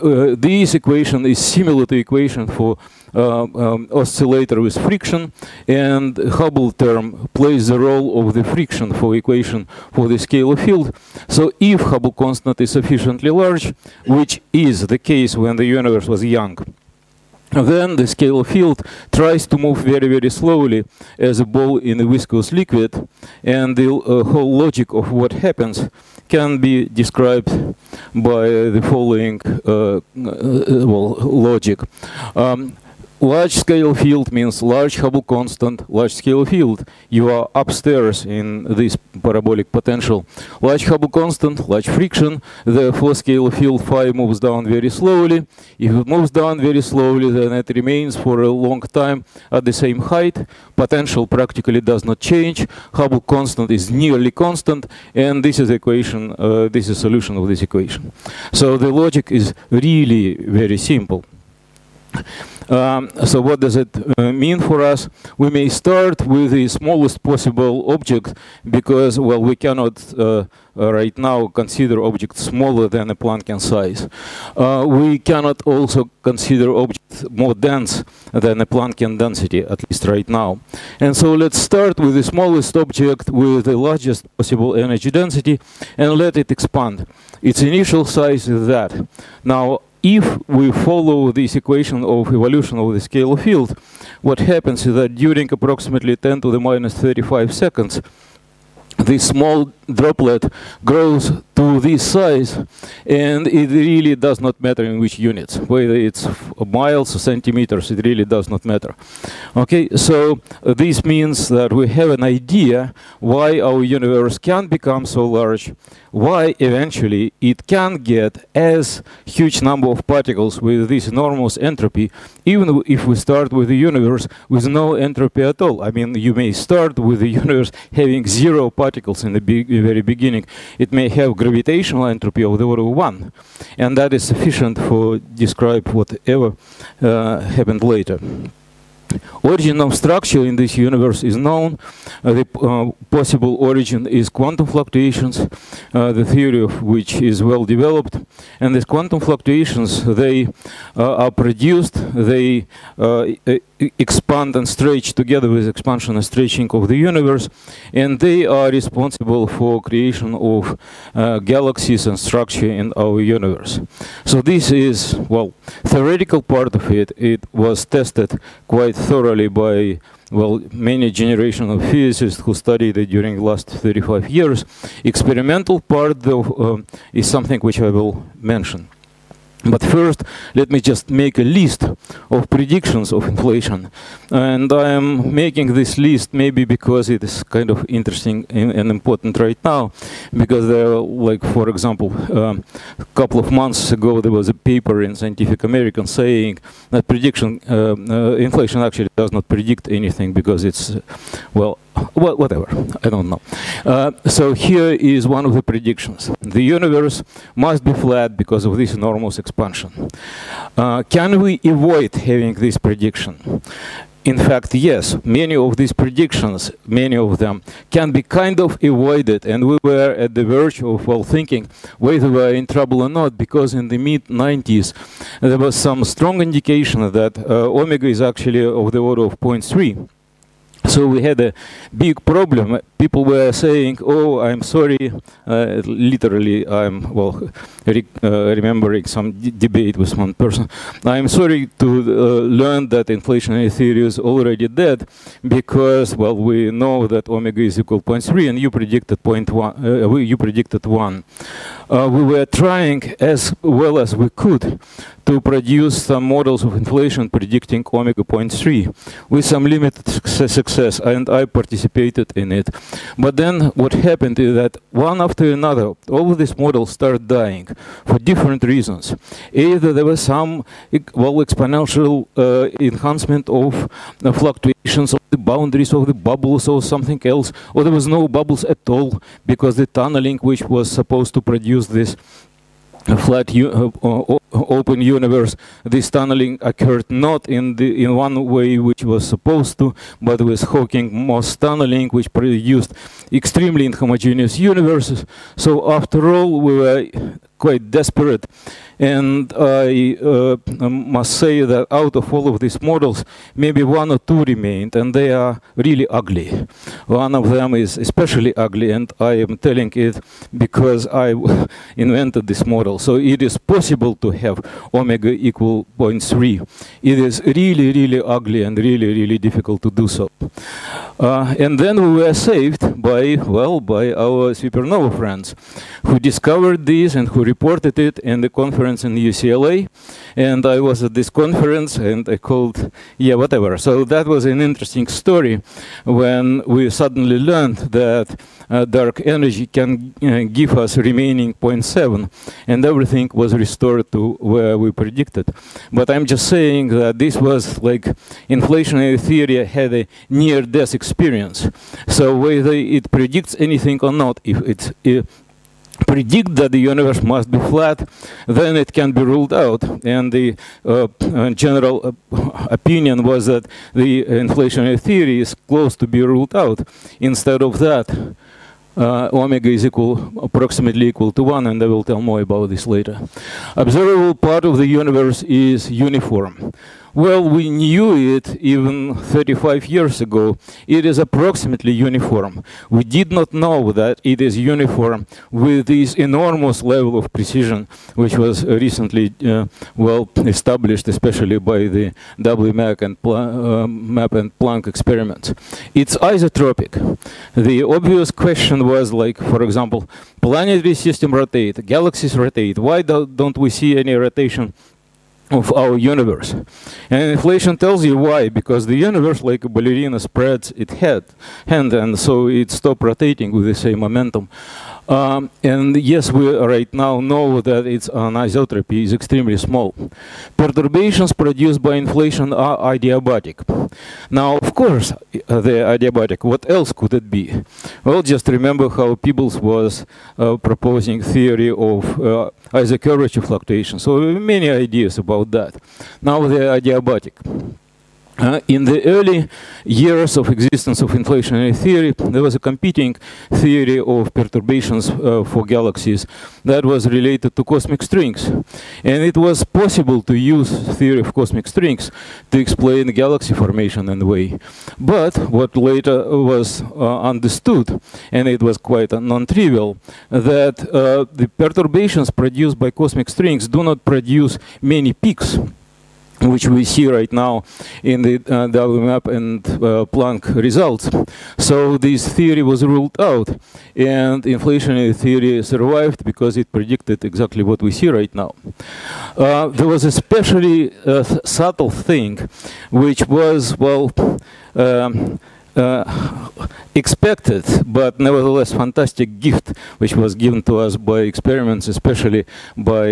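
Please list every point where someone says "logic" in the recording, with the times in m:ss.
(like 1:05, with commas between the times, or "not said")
0:24, 0:31, 0:58.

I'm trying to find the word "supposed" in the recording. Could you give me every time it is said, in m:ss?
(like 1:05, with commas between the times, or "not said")
4:40, 4:49.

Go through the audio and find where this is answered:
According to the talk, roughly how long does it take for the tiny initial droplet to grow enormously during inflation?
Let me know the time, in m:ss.
1:36.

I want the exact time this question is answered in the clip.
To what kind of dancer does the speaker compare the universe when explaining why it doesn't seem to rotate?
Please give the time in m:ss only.
6:49.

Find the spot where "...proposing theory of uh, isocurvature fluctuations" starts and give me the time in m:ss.
7:10.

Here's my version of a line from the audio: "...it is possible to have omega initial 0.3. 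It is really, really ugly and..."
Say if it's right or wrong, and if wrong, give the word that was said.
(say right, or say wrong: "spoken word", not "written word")
wrong: "equal", not "initial".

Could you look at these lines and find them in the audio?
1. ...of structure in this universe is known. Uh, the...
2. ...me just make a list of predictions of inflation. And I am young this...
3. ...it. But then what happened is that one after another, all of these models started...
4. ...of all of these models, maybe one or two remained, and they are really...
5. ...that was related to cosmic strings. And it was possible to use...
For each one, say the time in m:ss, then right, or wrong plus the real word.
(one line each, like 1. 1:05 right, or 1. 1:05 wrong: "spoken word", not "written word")
1. 2:19 right
2. 3:00 wrong: "making", not "young"
3. 4:22 right
4. 5:02 right
5. 7:26 right.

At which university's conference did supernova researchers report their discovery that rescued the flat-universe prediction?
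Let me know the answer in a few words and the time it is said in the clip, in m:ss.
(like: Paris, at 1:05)
UCLA, at 5:29.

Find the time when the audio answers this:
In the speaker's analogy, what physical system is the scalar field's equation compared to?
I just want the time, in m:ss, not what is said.
0:03.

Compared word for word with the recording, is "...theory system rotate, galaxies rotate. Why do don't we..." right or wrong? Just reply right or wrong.
wrong.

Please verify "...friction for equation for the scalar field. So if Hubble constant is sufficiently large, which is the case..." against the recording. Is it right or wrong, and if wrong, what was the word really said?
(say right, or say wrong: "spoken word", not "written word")
right.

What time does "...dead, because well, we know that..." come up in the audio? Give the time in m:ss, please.
4:04.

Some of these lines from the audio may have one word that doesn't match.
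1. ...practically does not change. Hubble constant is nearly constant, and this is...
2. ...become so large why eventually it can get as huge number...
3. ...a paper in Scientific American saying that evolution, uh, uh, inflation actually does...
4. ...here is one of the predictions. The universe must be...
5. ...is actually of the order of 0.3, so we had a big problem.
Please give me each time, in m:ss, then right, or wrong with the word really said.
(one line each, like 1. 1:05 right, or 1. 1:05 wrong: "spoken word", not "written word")
1. 0:51 right
2. 1:54 right
3. 3:14 wrong: "prediction", not "evolution"
4. 3:24 right
5. 3:48 right.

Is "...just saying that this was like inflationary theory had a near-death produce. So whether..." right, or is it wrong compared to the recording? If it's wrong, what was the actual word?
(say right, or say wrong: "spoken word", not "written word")
wrong: "experience", not "produce".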